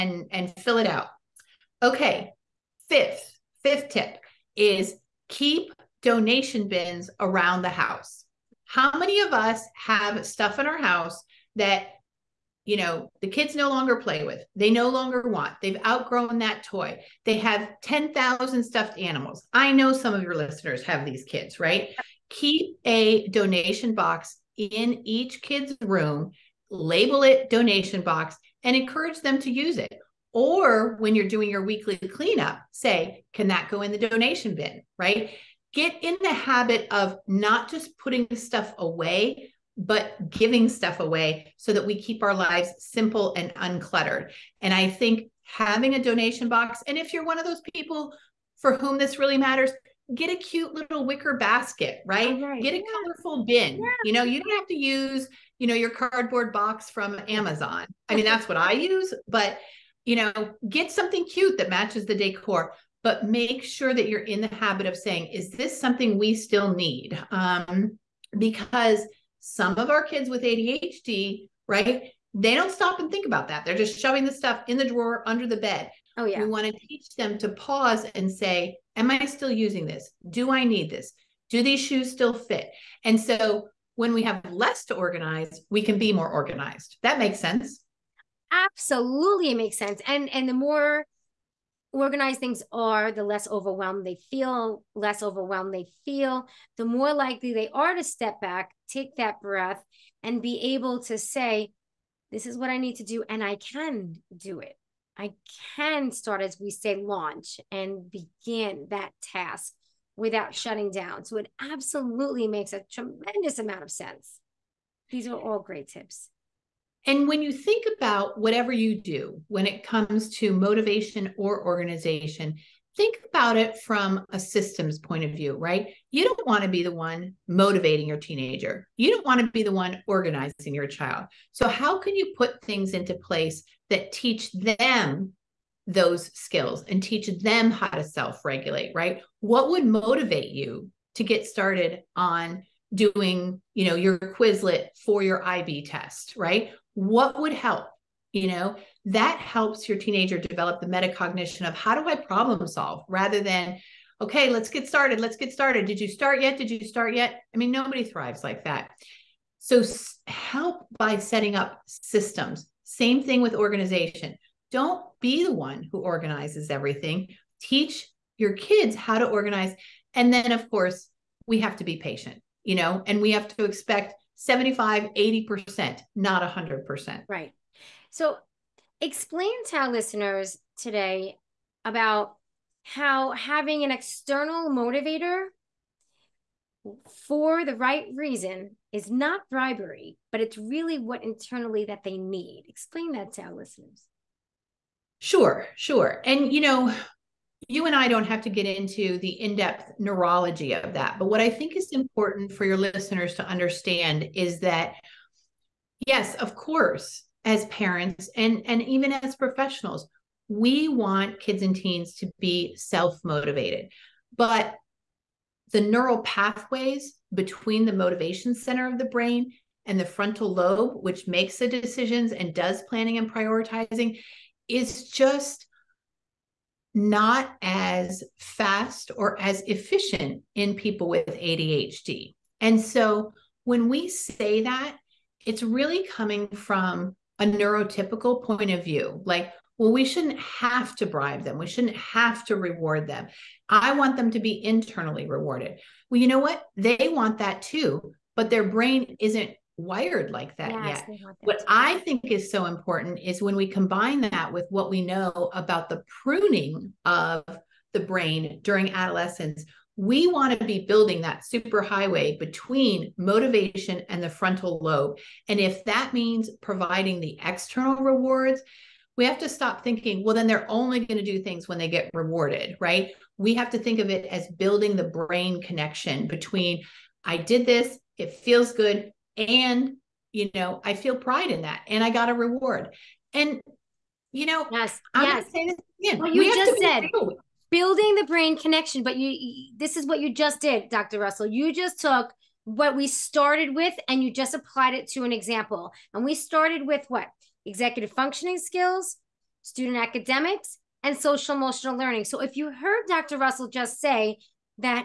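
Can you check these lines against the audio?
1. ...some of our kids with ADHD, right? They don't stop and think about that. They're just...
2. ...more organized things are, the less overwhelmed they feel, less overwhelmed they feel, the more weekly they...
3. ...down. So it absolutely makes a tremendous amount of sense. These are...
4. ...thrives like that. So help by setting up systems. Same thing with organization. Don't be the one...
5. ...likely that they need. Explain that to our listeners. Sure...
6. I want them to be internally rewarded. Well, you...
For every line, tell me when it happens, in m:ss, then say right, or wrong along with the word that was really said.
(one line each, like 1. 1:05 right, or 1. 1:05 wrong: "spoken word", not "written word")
1. 1:09 right
2. 1:30 wrong: "likely", not "weekly"
3. 1:50 right
4. 2:38 right
5. 3:11 wrong: "internally", not "likely"
6. 4:03 right.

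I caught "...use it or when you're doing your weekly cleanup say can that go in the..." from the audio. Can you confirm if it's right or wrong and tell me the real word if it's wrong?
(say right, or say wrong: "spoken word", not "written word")
right.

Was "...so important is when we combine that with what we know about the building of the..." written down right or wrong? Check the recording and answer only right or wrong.
wrong.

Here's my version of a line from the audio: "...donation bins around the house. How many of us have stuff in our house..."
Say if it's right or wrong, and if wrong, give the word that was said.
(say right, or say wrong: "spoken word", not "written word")
right.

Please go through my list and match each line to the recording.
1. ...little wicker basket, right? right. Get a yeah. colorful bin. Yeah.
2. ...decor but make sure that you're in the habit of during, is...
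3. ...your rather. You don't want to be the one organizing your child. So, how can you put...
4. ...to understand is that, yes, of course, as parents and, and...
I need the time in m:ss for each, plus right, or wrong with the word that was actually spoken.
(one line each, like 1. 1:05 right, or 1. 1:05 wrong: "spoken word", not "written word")
1. 0:50 right
2. 1:02 wrong: "saying", not "during"
3. 2:08 wrong: "teenager", not "rather"
4. 3:23 right.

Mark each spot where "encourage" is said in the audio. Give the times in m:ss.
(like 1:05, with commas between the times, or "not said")
0:28.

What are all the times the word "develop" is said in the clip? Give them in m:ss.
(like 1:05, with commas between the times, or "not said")
2:30.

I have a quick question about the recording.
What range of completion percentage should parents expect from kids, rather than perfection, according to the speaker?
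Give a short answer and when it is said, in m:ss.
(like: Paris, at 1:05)
75 to 80%, at 2:54.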